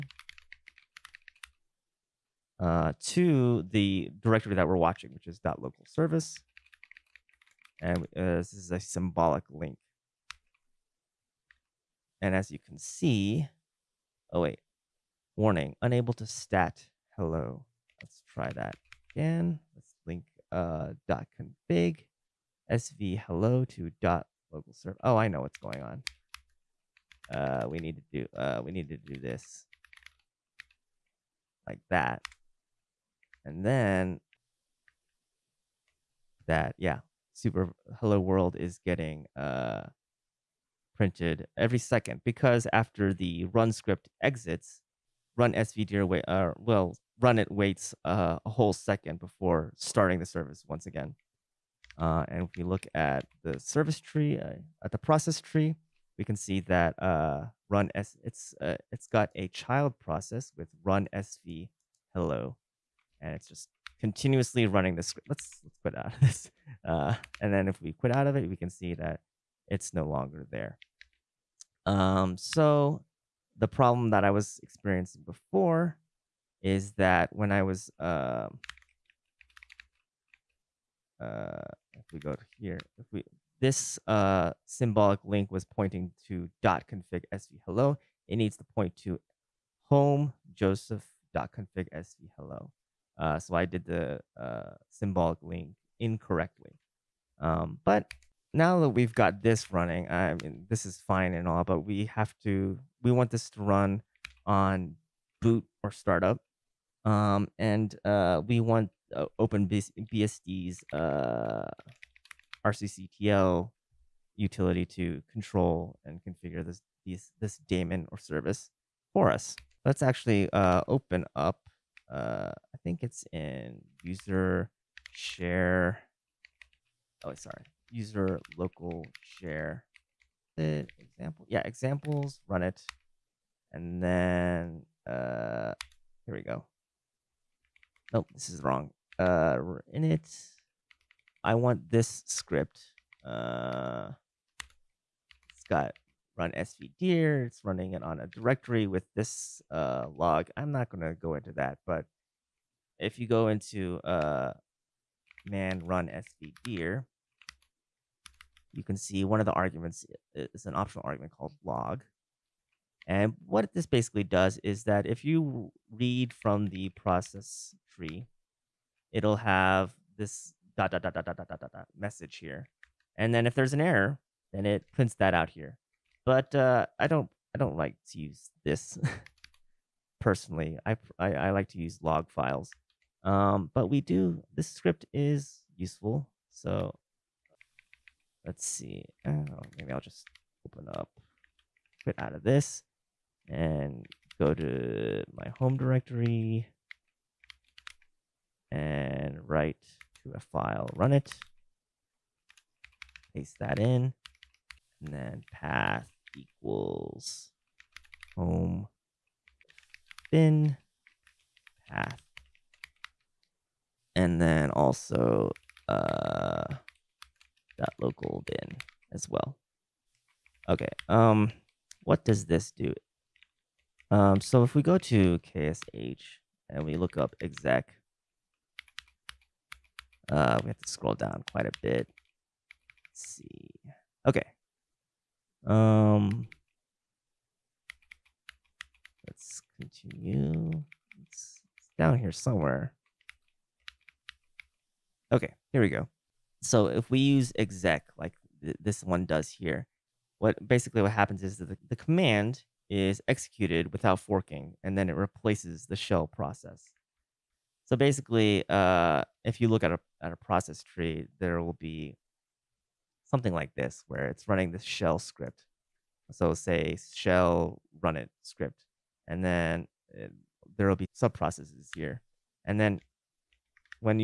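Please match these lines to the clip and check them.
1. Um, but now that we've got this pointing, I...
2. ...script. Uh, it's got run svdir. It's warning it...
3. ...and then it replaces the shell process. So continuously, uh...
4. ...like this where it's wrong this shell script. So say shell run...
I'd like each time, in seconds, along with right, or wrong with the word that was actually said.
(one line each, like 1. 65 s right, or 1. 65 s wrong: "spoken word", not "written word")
1. 97 s wrong: "running", not "pointing"
2. 142 s wrong: "running", not "warning"
3. 254 s wrong: "basically", not "continuously"
4. 263 s wrong: "running", not "wrong".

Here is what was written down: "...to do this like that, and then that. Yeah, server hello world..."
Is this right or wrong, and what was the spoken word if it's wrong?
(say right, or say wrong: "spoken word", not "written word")
wrong: "super", not "server".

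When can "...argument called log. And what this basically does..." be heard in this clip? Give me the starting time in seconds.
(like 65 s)
161 s.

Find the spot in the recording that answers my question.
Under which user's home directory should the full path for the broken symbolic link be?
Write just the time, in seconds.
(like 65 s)
90 s.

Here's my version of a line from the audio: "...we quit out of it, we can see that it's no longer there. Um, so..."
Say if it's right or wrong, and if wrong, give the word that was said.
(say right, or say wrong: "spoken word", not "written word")
right.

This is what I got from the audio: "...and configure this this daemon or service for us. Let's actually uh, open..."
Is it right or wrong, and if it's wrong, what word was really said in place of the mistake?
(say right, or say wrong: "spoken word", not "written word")
right.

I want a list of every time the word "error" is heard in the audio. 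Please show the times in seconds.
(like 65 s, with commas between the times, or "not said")
173 s.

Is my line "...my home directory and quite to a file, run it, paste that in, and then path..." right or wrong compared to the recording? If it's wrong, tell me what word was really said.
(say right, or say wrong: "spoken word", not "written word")
wrong: "write", not "quite".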